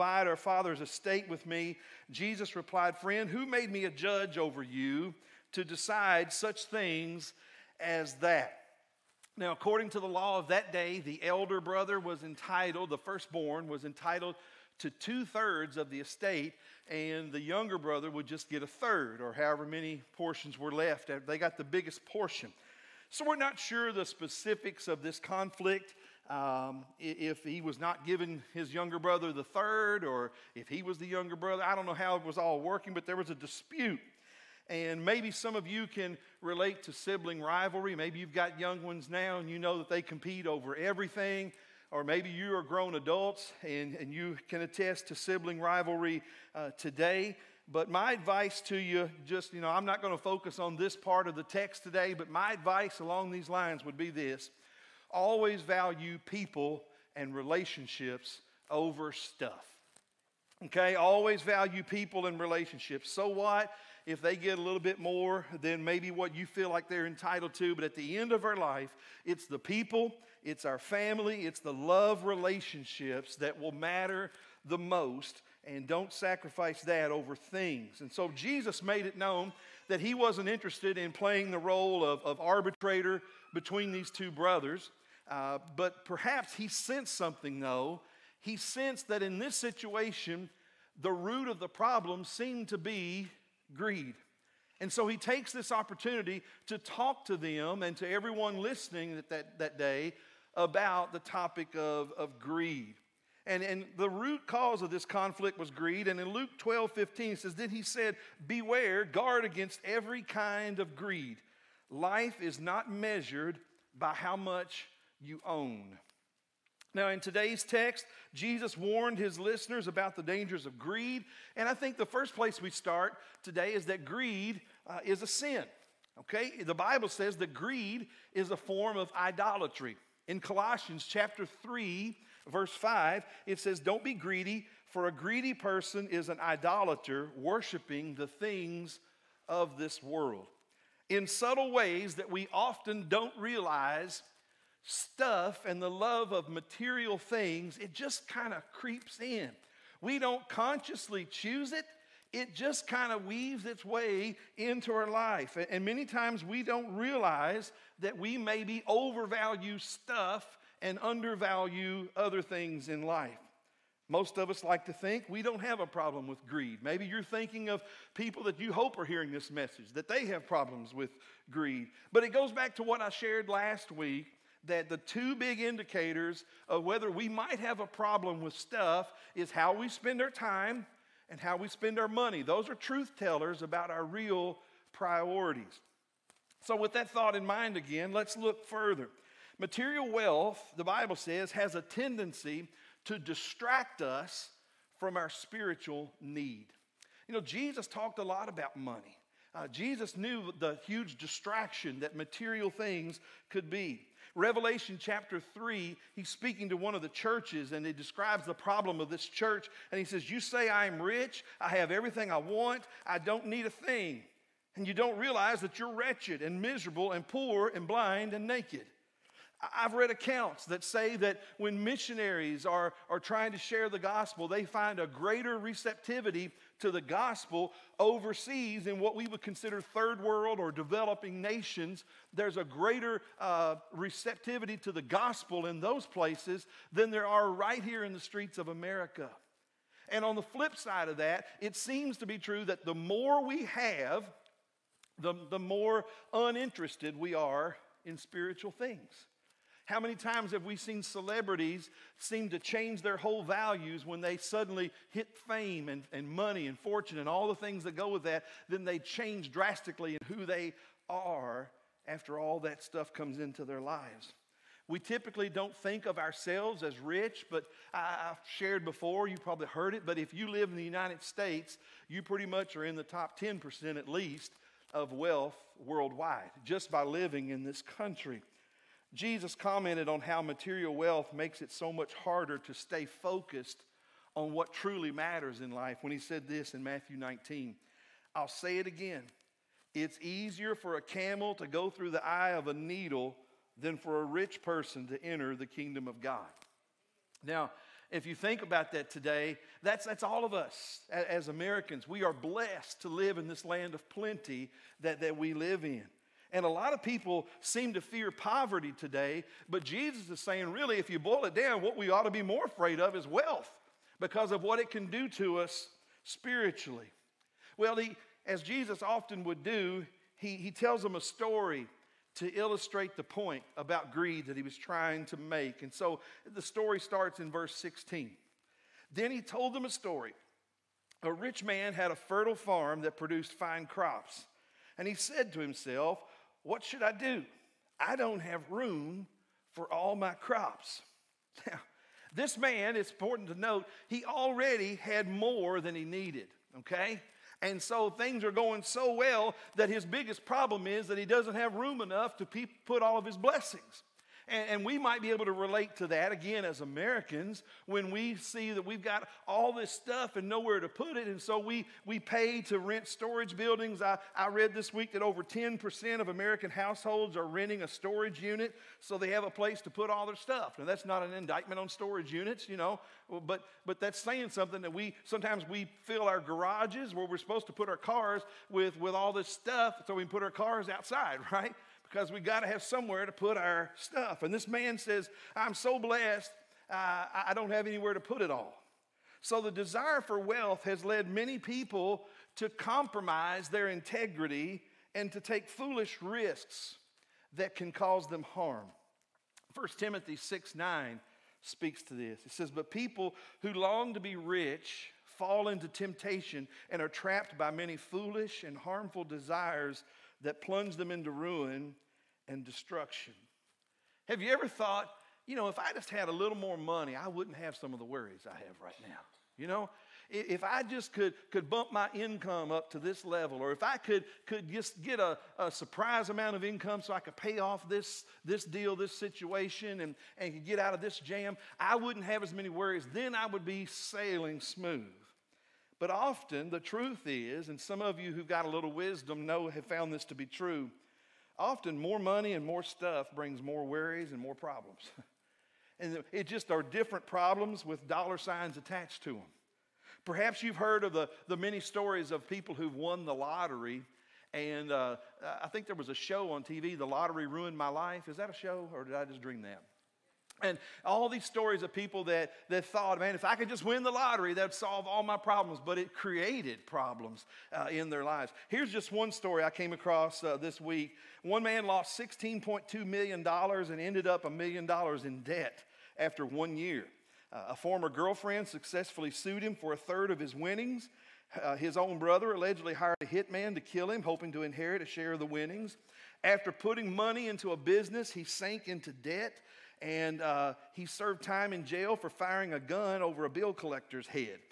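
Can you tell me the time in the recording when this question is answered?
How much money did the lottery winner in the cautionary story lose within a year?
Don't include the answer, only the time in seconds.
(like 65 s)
472 s.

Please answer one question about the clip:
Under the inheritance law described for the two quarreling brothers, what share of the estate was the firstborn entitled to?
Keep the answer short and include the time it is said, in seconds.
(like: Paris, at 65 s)
2/3, at 14 s.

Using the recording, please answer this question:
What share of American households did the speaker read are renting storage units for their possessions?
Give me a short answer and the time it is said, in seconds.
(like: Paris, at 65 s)
over 10%, at 365 s.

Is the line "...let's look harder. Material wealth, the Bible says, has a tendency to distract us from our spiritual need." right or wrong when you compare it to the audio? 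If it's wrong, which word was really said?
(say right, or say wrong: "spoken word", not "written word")
wrong: "further", not "harder".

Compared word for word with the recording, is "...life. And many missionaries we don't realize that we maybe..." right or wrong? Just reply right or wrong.
wrong.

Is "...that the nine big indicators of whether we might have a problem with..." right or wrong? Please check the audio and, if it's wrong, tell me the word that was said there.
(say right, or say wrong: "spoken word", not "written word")
wrong: "two", not "nine".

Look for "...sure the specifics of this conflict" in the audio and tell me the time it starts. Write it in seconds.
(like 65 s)
23 s.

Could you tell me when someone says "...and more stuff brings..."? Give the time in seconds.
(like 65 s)
442 s.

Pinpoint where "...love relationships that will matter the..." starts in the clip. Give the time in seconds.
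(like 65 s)
71 s.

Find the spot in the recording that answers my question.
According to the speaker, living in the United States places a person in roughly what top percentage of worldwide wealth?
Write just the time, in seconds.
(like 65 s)
273 s.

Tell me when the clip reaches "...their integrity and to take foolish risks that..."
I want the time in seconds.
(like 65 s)
393 s.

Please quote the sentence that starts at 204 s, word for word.
Revelation chapter 3, he's speaking to one of the churches and he describes the problem of this church.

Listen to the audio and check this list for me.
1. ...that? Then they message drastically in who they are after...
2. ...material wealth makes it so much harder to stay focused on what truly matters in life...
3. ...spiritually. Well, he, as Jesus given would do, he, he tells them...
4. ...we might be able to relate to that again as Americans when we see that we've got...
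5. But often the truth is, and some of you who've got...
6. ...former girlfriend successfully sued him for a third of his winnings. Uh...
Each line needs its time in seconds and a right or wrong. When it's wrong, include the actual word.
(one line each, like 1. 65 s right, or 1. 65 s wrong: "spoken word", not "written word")
1. 258 s wrong: "change", not "message"
2. 280 s right
3. 316 s wrong: "often", not "given"
4. 354 s right
5. 435 s right
6. 477 s right.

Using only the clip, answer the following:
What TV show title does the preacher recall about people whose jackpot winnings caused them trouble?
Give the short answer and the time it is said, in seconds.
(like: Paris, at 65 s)
The Lottery Ruined My Life, at 456 s.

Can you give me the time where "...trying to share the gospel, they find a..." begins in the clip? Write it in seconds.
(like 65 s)
223 s.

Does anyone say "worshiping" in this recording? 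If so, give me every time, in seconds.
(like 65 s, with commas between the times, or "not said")
137 s.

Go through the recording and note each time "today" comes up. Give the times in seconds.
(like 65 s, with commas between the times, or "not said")
46 s, 51 s, 117 s, 123 s, 299 s, 308 s.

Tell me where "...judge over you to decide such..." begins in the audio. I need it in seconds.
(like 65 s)
3 s.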